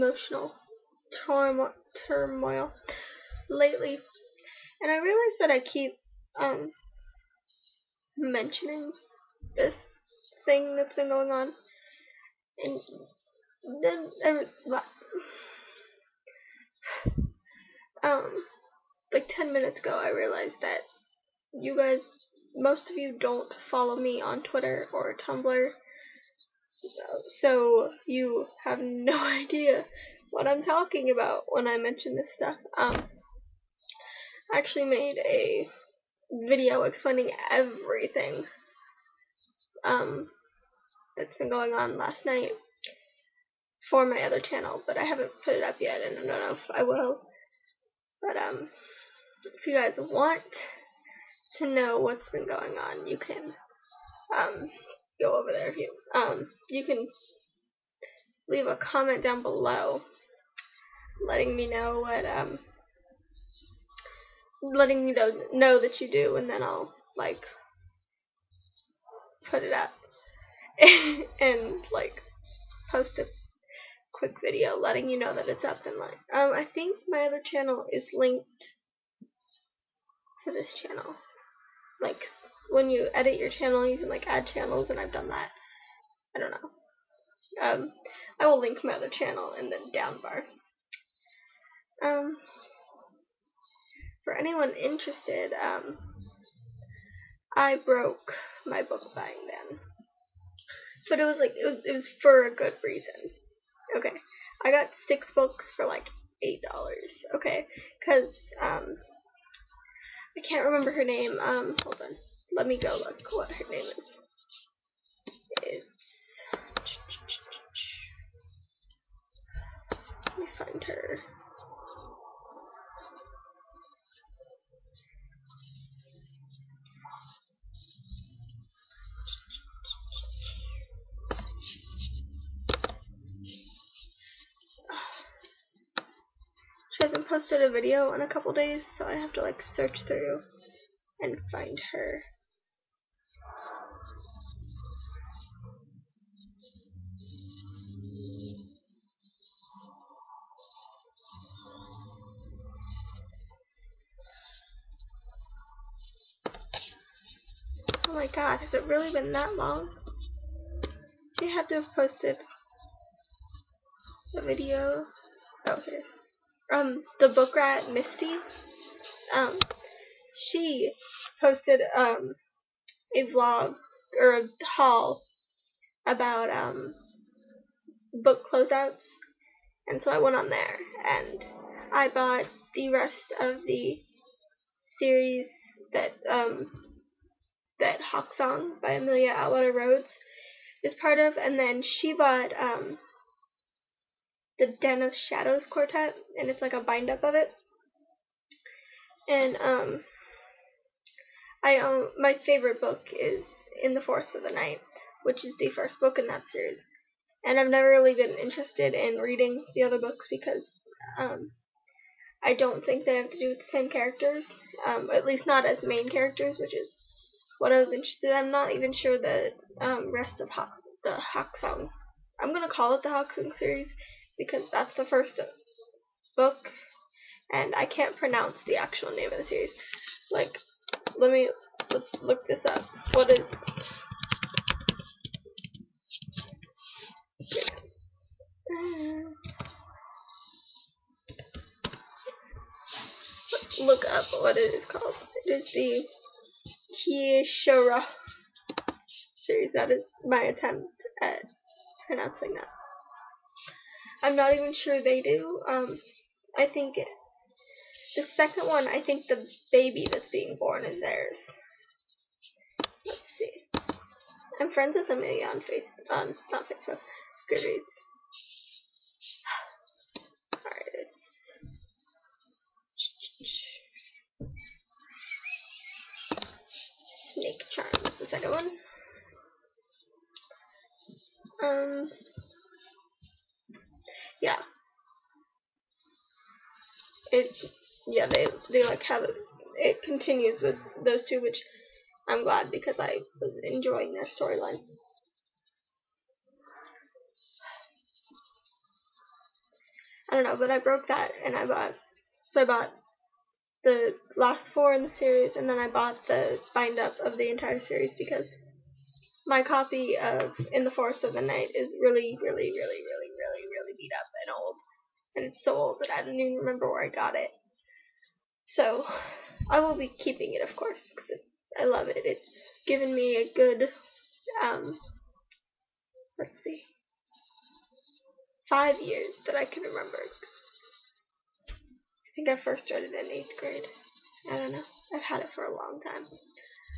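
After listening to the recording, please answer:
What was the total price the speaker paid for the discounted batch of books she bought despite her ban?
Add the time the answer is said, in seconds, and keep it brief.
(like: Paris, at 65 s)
$8, at 106 s.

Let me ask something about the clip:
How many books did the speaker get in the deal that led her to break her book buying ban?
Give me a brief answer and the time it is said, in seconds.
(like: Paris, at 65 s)
6, at 104 s.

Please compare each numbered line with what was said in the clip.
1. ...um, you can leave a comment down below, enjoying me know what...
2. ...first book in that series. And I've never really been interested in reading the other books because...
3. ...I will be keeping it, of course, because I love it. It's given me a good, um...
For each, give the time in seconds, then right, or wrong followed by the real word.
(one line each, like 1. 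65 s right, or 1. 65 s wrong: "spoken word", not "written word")
1. 56 s wrong: "letting", not "enjoying"
2. 205 s right
3. 319 s right.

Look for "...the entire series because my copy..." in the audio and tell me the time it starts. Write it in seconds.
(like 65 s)
307 s.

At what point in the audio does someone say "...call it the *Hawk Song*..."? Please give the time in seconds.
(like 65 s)
222 s.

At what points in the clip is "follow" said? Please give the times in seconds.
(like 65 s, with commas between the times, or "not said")
23 s.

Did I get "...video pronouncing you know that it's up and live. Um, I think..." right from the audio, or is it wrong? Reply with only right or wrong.
wrong.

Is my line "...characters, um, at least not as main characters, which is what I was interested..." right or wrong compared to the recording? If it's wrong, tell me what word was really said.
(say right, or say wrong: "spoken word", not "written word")
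right.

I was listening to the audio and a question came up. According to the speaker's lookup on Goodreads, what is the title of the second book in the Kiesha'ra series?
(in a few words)
Snake Charm.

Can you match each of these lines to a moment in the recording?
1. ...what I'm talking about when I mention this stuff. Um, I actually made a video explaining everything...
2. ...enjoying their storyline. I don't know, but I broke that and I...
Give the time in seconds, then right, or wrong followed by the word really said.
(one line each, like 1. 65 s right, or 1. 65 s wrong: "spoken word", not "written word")
1. 30 s right
2. 293 s right.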